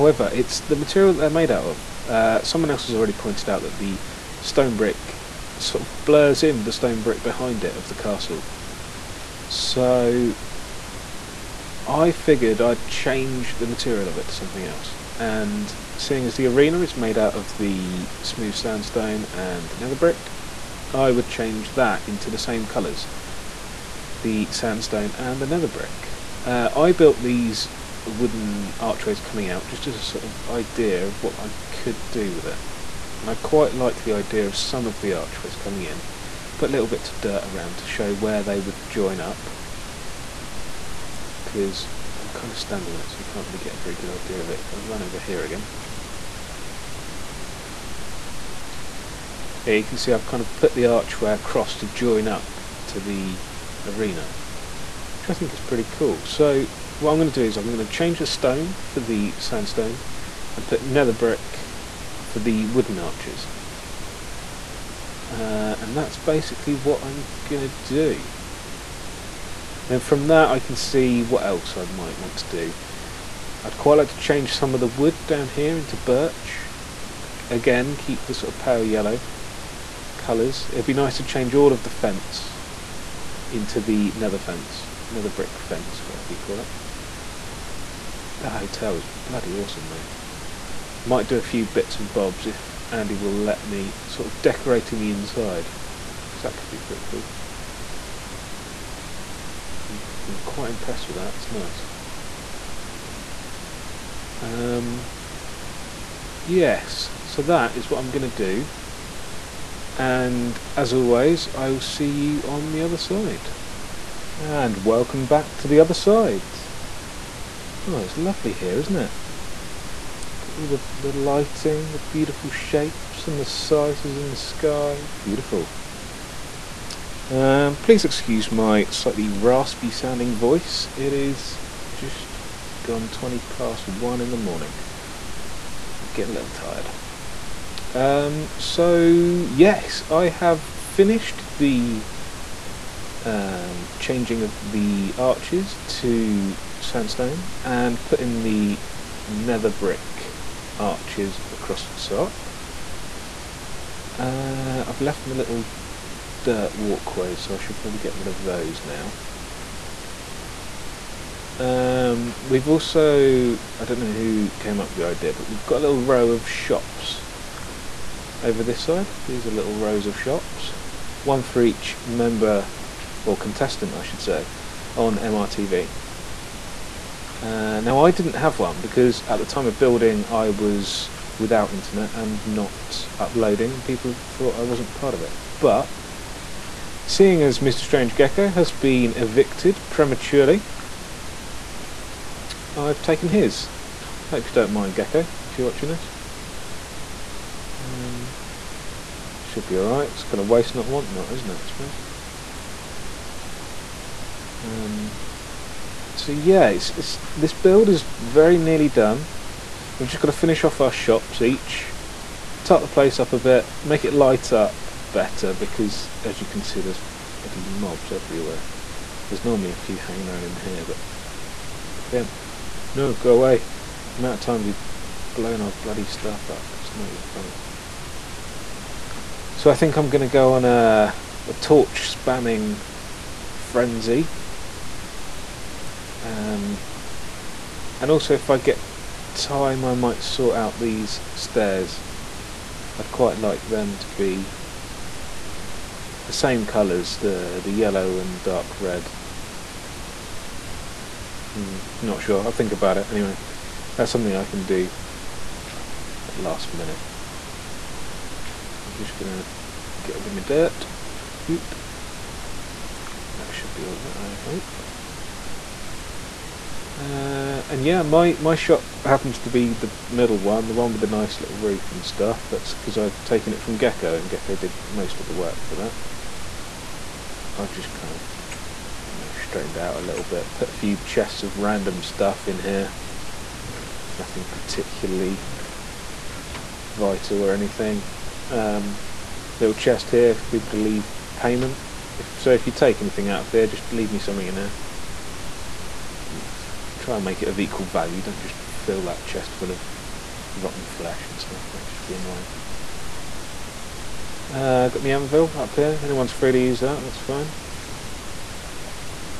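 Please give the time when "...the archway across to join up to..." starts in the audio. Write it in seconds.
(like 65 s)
50 s.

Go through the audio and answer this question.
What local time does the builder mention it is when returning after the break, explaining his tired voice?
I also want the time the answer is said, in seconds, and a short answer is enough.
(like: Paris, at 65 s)
20 past 1, at 133 s.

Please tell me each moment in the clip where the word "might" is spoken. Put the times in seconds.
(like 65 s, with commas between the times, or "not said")
71 s, 91 s, 239 s.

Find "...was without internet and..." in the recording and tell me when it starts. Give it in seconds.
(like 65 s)
180 s.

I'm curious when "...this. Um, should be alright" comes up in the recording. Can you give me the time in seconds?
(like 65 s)
195 s.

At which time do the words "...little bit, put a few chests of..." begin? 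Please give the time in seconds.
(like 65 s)
280 s.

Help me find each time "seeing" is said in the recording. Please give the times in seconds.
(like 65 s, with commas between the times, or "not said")
15 s, 187 s.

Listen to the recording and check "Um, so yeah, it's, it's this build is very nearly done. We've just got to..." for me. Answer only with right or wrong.
right.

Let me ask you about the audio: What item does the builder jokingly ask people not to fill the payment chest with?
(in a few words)
Rotten flesh.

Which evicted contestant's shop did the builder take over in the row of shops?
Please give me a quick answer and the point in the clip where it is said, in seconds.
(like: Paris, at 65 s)
Mr. Strange Gecko, at 187 s.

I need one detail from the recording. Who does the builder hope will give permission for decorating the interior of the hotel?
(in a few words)
Andy.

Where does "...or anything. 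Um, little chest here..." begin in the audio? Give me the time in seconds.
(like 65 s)
287 s.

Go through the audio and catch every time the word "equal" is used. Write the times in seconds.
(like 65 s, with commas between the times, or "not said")
297 s.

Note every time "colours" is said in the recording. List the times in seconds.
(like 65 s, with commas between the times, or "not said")
22 s, 80 s, 246 s.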